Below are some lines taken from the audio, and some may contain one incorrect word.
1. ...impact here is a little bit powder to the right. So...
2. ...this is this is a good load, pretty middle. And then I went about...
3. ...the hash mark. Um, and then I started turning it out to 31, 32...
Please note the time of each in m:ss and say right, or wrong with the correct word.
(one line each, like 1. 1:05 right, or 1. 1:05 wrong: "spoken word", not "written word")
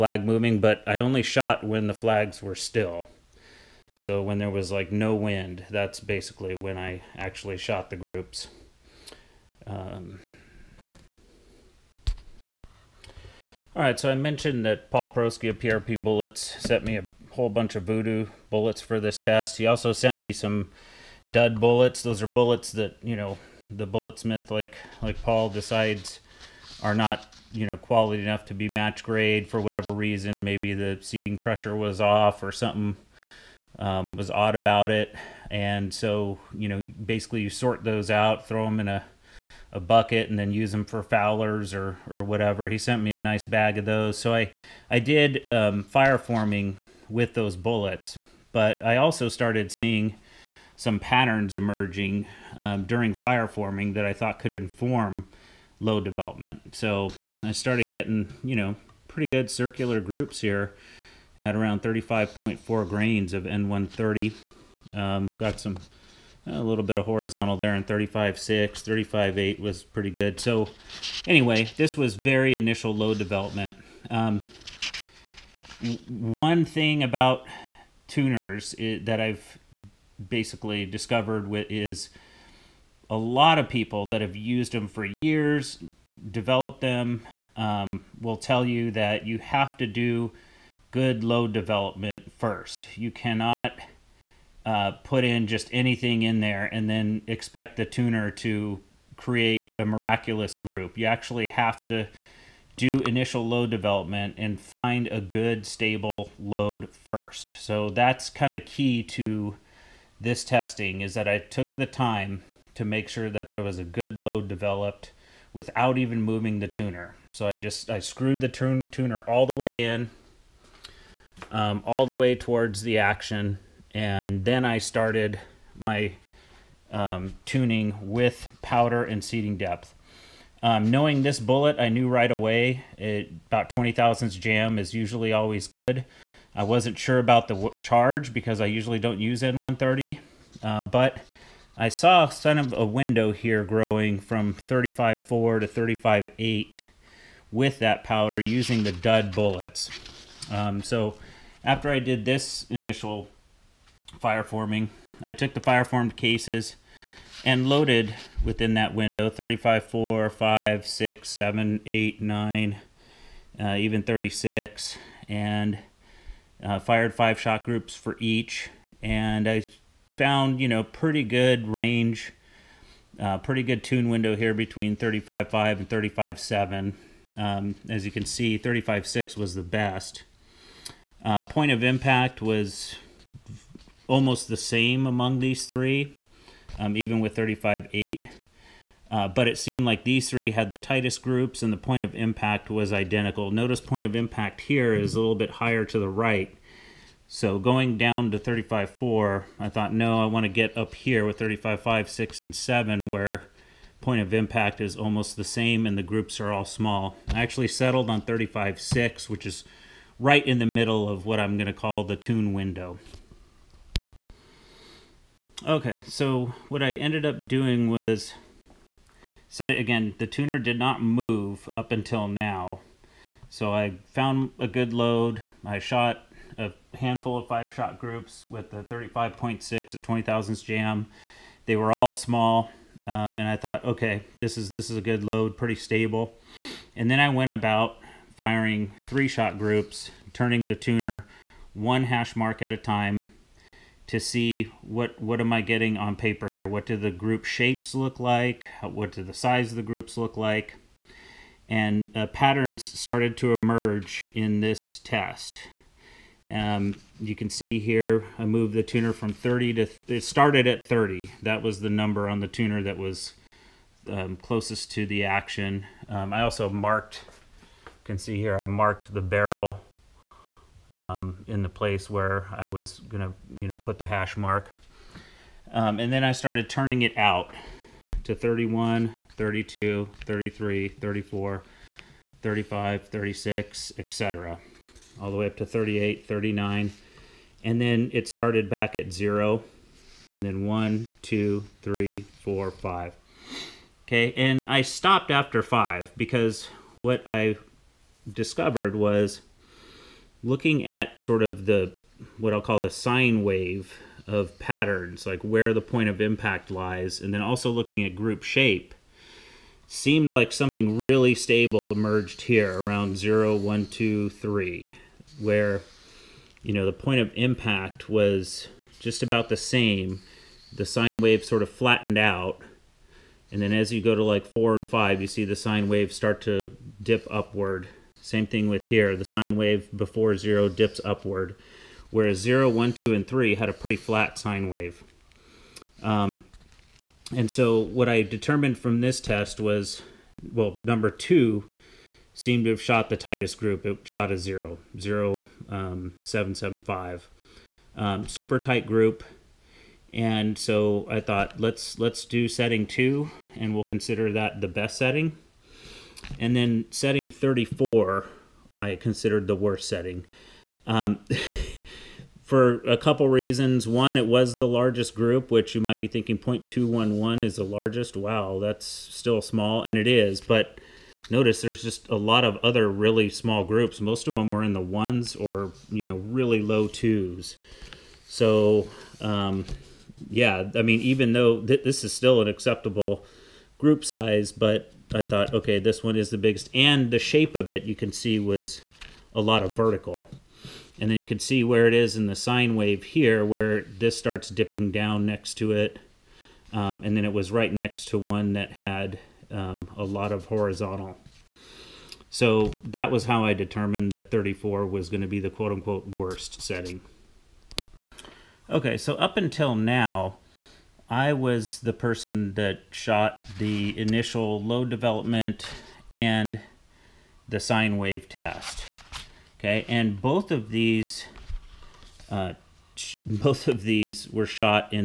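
1. 3:14 wrong: "higher", not "powder"
2. 3:54 wrong: "stable", not "middle"
3. 4:33 right.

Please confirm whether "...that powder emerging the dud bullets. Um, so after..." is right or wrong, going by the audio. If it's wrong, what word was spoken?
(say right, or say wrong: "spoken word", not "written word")
wrong: "using", not "emerging".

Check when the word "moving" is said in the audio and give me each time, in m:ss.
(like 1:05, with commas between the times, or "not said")
0:00, 1:56.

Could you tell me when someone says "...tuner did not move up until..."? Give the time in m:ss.
3:40.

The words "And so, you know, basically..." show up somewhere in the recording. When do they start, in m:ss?
0:35.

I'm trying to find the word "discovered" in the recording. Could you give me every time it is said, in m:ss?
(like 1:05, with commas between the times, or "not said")
1:20, 4:58.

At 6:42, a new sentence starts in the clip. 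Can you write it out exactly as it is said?
So that was how I determined that 34 was going to be the quote-unquote worst setting.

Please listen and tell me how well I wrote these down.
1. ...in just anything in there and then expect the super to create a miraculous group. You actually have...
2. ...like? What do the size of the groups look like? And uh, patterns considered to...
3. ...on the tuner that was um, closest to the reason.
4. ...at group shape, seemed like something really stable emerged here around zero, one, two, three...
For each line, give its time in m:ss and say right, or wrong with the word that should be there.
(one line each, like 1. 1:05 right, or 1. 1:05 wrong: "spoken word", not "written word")
1. 1:35 wrong: "tuner", not "super"
2. 4:08 wrong: "started", not "considered"
3. 4:22 wrong: "action", not "reason"
4. 5:08 right.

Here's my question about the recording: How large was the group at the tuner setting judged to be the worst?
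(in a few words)
0.211.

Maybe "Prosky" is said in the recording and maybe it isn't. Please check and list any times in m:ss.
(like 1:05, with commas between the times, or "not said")
0:15.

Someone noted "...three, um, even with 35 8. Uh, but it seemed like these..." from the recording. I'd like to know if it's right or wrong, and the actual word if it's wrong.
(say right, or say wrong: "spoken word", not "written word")
right.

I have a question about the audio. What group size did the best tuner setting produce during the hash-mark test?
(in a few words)
0.0775.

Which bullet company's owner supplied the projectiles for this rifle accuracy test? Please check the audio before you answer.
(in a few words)
PRP Bullets.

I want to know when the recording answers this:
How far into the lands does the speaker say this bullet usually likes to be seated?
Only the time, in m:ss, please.
2:13.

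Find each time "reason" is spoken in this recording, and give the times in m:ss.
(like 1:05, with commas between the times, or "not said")
0:29, 6:03.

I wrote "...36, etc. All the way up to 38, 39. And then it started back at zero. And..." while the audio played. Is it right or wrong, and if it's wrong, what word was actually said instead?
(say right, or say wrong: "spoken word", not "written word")
right.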